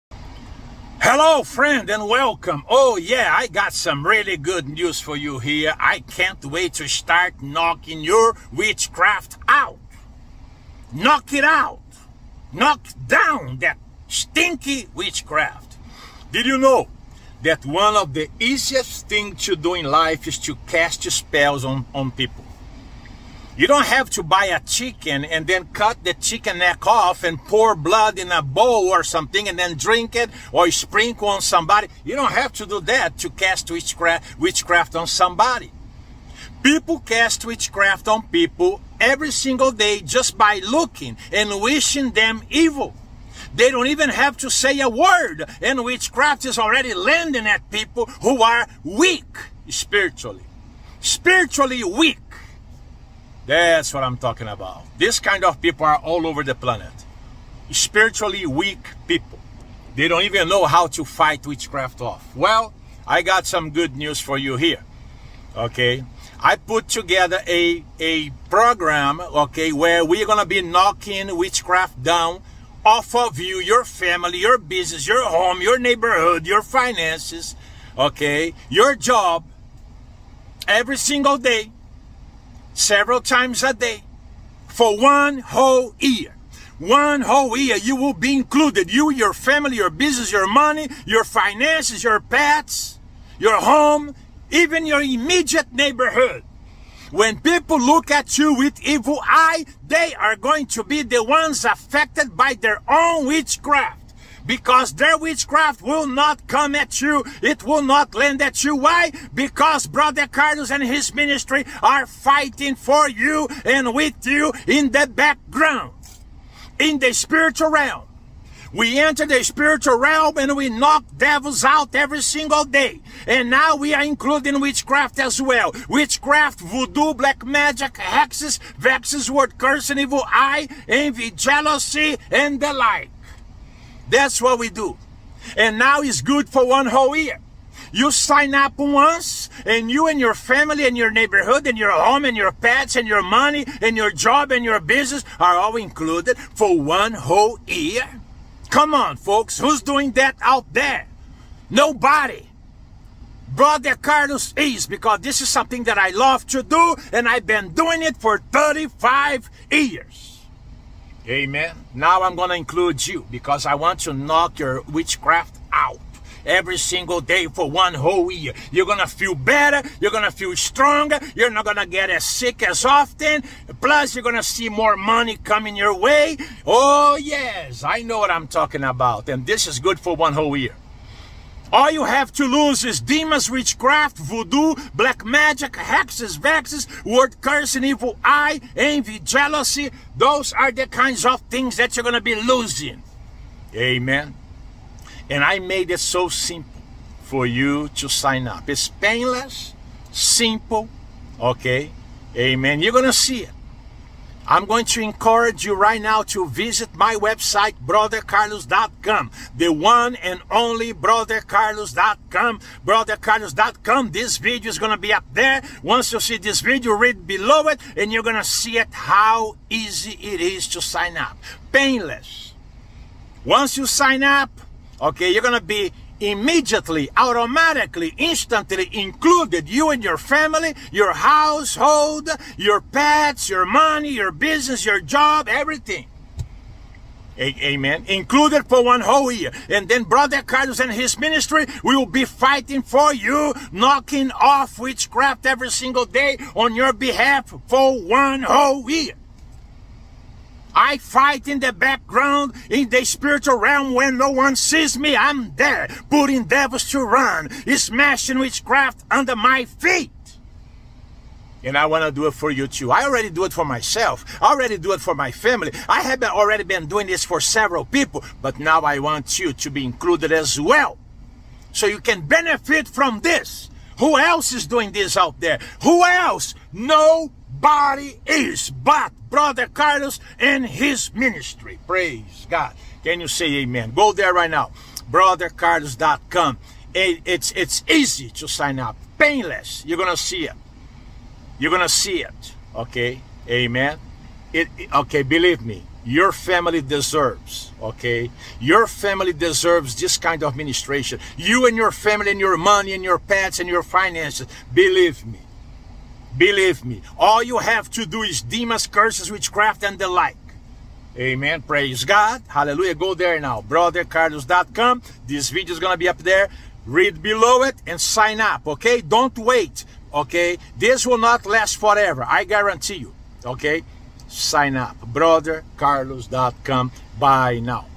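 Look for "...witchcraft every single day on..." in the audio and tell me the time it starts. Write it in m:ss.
4:04.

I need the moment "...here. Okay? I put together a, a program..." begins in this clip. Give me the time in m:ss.
1:04.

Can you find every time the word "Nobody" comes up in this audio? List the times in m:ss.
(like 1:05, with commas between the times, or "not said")
2:31, 4:36.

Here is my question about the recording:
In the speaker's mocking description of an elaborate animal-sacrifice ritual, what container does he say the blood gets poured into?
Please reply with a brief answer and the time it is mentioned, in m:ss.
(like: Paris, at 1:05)
bowl, at 0:28.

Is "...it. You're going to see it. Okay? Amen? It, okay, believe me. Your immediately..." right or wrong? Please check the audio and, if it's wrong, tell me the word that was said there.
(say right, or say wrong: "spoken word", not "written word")
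wrong: "family", not "immediately".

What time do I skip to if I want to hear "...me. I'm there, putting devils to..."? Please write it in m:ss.
4:14.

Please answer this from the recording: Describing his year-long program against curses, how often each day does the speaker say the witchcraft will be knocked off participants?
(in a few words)
several times a day.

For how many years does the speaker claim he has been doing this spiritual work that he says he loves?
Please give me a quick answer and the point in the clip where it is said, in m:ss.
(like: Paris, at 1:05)
35 years, at 2:38.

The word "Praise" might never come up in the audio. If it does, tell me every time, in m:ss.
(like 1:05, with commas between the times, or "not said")
4:41, 5:11.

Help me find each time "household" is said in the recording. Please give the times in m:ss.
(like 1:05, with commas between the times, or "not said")
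3:51.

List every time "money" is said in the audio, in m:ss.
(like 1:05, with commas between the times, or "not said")
1:30, 2:23, 2:54, 3:53, 5:02.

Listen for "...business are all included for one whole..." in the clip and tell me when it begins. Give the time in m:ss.
2:24.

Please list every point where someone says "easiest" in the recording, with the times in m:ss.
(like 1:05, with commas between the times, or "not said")
0:18.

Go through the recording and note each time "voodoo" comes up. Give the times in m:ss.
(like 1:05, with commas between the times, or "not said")
2:06, 3:04.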